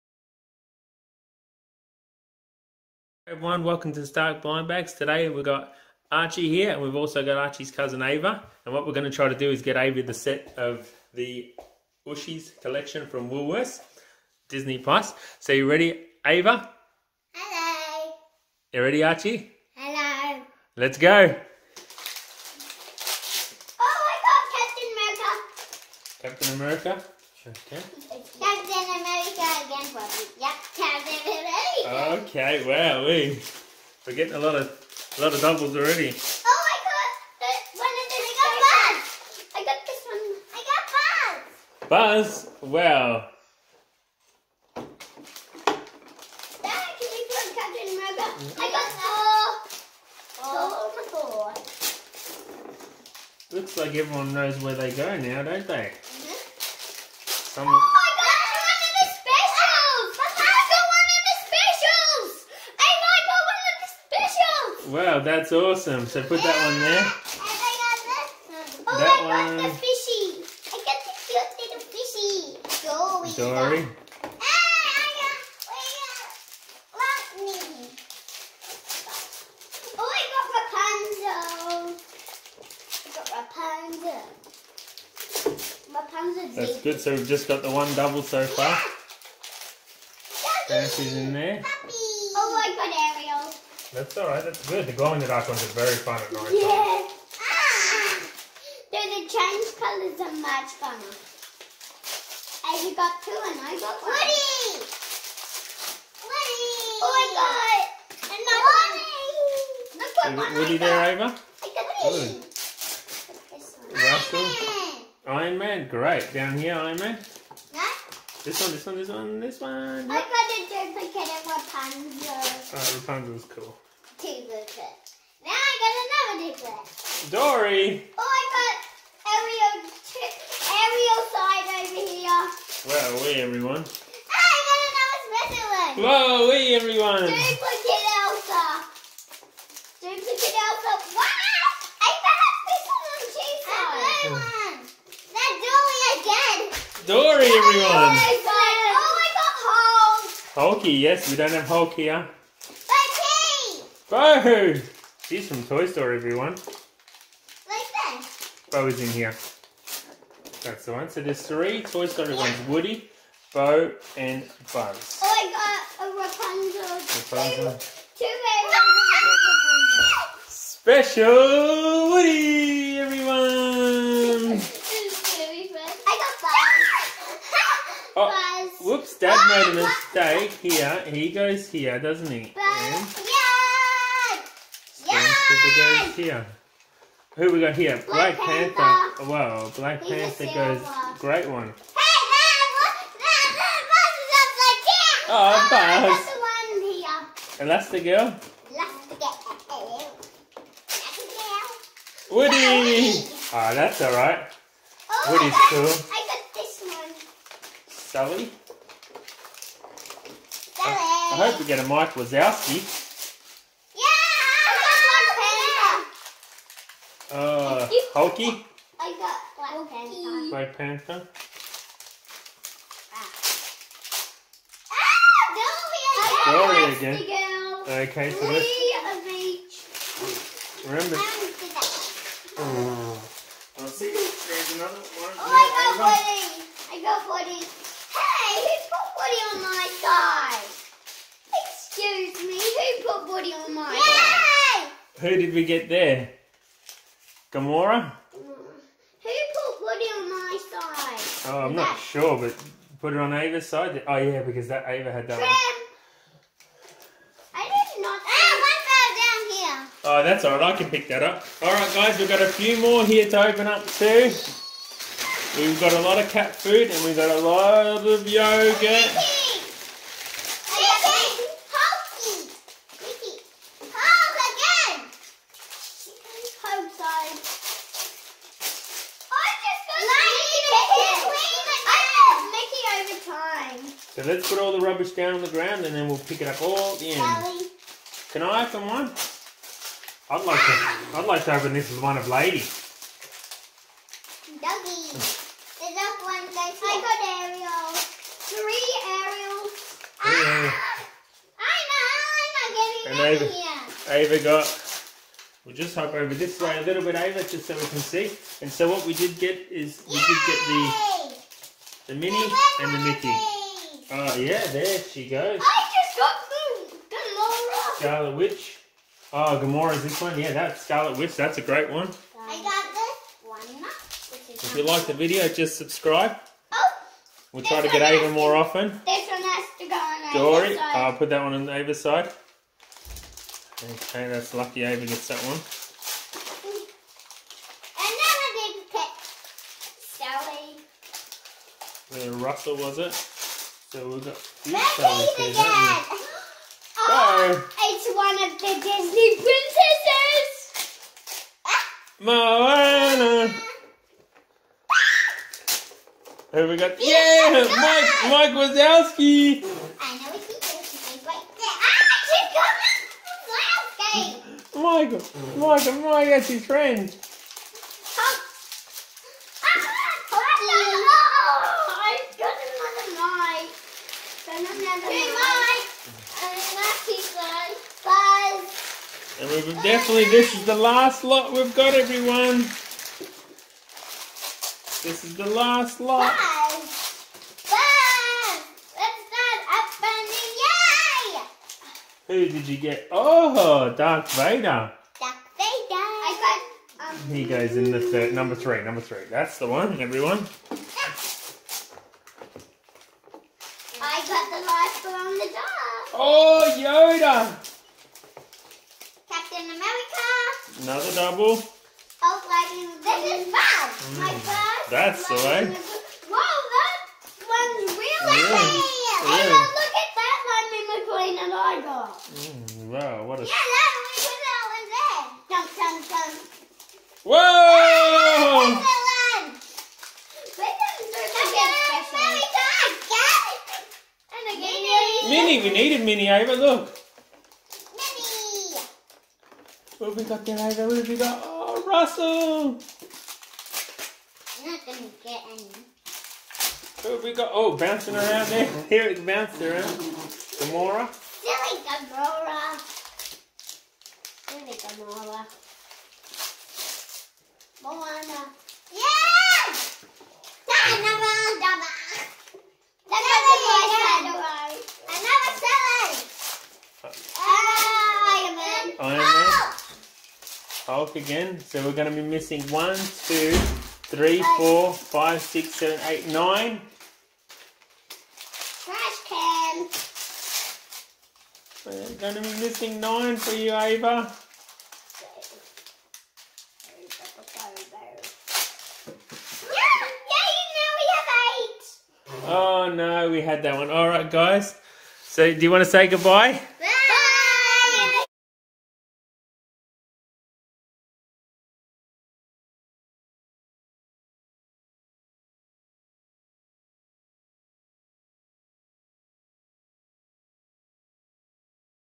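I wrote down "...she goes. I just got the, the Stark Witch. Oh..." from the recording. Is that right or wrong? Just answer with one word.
wrong.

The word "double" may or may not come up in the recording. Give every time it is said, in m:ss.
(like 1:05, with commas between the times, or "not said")
0:35, 1:27, 6:51.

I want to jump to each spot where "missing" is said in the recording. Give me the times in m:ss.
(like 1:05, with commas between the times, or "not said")
7:52, 8:02.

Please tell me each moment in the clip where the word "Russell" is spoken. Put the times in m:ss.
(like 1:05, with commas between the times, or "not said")
5:42, 7:21.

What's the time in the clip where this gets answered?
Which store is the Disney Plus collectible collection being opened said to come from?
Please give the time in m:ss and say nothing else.
0:13.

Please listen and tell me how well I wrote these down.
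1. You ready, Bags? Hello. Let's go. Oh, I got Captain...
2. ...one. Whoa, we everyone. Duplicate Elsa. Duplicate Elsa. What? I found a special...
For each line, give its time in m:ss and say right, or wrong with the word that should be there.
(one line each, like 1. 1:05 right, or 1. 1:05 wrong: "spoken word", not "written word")
1. 0:18 wrong: "Archie", not "Bags"
2. 2:15 right.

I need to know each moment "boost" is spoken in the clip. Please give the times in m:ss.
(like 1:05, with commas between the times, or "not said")
not said.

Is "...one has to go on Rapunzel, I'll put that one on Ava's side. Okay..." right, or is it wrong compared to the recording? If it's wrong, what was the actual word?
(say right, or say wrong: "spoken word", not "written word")
wrong: "Dory", not "Rapunzel".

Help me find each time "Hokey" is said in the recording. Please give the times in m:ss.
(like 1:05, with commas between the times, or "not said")
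2:30.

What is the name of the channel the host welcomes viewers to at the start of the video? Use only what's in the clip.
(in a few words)
Stark Blind Bags.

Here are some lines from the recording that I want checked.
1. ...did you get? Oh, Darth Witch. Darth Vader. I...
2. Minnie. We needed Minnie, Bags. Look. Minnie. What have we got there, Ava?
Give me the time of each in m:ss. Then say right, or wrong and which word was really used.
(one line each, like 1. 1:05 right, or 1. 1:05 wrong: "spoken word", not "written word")
1. 6:32 wrong: "Vader", not "Witch"
2. 7:15 wrong: "Ava", not "Bags".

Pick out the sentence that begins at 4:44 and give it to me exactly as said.
So let's put all the rubbish down on the ground and then we'll pick it up all at the end.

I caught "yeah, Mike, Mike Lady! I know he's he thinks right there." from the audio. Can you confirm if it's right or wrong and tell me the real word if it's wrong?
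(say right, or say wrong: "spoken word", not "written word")
wrong: "Wazowski", not "Lady".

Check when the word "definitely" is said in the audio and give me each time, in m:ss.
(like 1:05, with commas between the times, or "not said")
6:19.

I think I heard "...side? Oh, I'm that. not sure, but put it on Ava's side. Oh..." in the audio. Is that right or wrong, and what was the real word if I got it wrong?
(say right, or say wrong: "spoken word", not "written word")
right.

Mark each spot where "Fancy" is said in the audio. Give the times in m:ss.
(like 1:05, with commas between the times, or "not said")
1:30.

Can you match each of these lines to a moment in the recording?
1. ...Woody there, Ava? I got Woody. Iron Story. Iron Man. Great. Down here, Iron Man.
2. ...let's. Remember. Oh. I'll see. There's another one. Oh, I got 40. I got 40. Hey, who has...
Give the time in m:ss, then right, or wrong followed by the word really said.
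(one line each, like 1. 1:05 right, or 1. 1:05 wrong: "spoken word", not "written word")
1. 1:50 wrong: "Man", not "Story"
2. 3:48 right.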